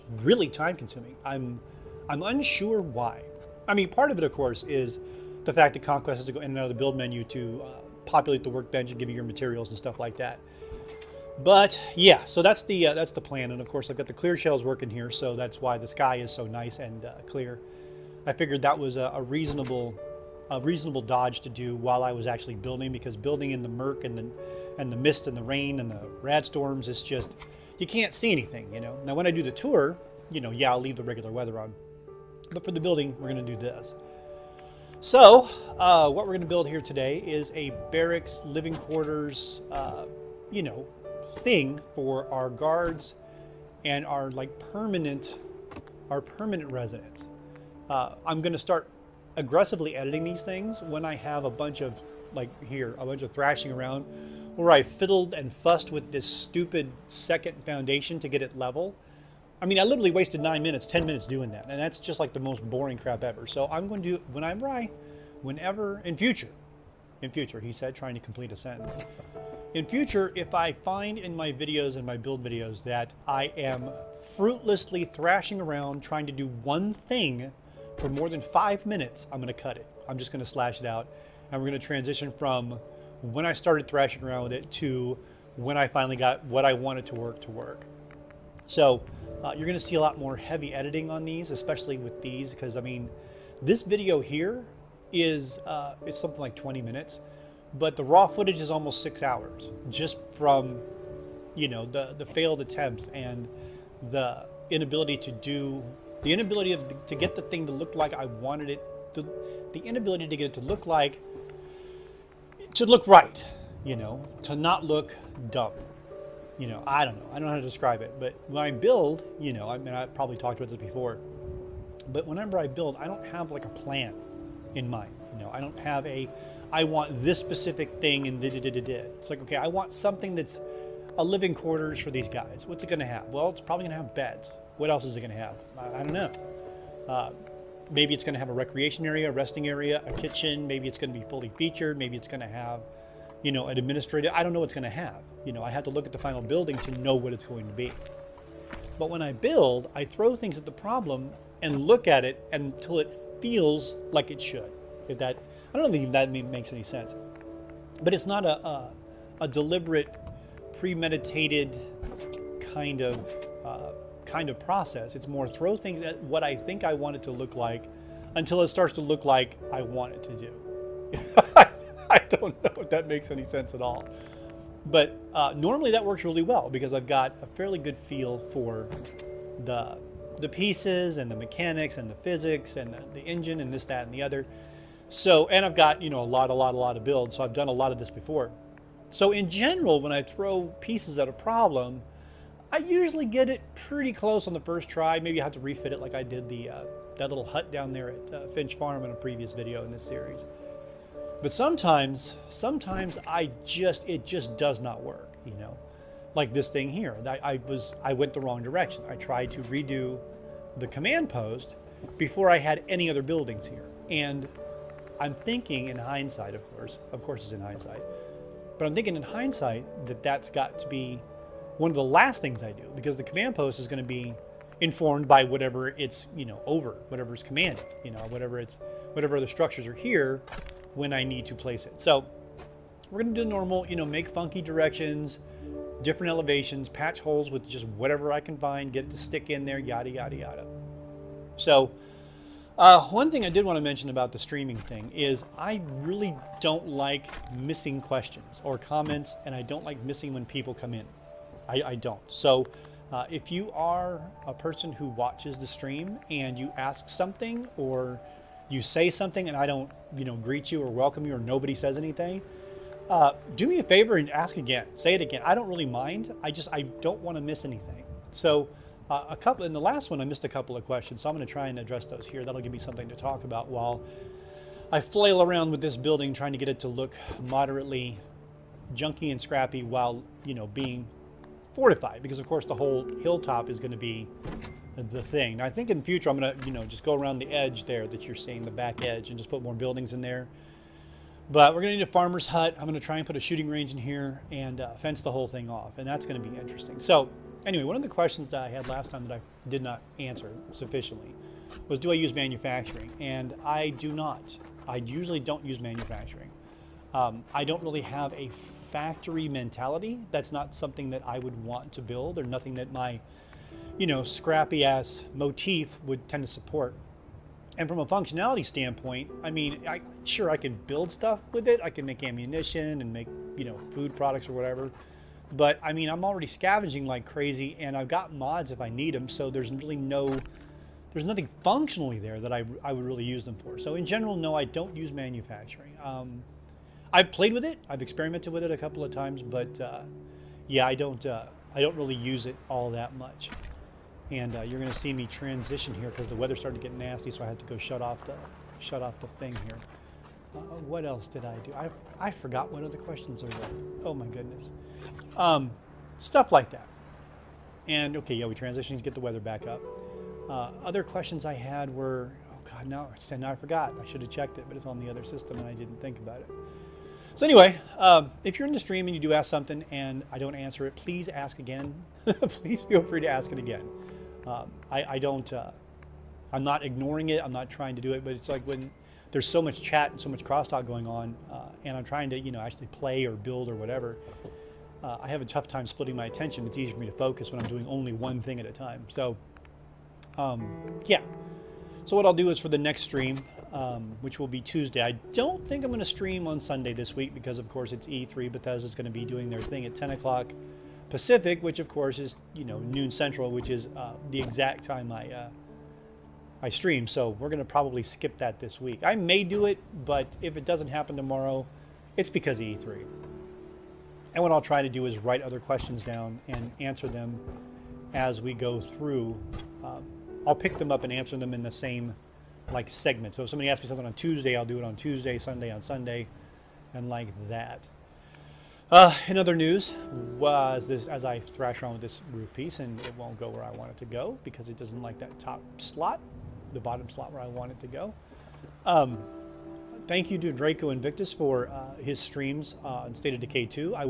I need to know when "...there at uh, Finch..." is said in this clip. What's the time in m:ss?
3:17.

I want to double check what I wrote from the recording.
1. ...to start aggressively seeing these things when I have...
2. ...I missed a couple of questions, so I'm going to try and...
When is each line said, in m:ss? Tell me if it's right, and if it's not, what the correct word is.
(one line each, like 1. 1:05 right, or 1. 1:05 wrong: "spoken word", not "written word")
1. 0:48 wrong: "editing", not "seeing"
2. 4:30 right.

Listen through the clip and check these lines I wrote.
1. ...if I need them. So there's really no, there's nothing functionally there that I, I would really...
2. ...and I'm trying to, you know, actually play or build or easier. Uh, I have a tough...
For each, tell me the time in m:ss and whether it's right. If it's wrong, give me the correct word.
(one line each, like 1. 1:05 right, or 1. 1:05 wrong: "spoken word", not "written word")
1. 5:28 right
2. 6:21 wrong: "whatever", not "easier".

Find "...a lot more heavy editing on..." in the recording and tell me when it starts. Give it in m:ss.
1:29.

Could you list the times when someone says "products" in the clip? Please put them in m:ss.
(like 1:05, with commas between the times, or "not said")
5:24.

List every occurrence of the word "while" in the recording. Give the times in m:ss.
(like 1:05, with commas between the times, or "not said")
0:21, 4:33, 4:39.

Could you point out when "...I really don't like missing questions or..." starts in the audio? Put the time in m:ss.
4:05.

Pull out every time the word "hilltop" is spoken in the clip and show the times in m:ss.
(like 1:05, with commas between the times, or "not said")
4:43.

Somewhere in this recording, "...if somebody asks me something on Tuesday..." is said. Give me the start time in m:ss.
7:03.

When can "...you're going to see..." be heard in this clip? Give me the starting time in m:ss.
5:44.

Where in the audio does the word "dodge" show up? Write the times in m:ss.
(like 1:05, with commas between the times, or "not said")
0:21.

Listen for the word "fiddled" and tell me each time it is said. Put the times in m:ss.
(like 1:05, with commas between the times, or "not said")
0:54.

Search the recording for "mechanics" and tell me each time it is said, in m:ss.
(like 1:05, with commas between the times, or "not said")
3:01.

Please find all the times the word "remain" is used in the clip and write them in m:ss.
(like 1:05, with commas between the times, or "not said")
not said.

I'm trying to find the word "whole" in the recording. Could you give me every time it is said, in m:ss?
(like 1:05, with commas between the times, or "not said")
4:42, 4:55.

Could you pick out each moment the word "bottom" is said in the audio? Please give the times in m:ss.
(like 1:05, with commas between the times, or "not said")
7:16.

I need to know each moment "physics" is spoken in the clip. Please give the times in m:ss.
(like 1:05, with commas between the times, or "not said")
3:02.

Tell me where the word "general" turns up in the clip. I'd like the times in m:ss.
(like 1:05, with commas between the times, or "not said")
3:09, 5:34.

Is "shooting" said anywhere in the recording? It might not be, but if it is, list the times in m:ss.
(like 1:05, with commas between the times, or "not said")
4:53.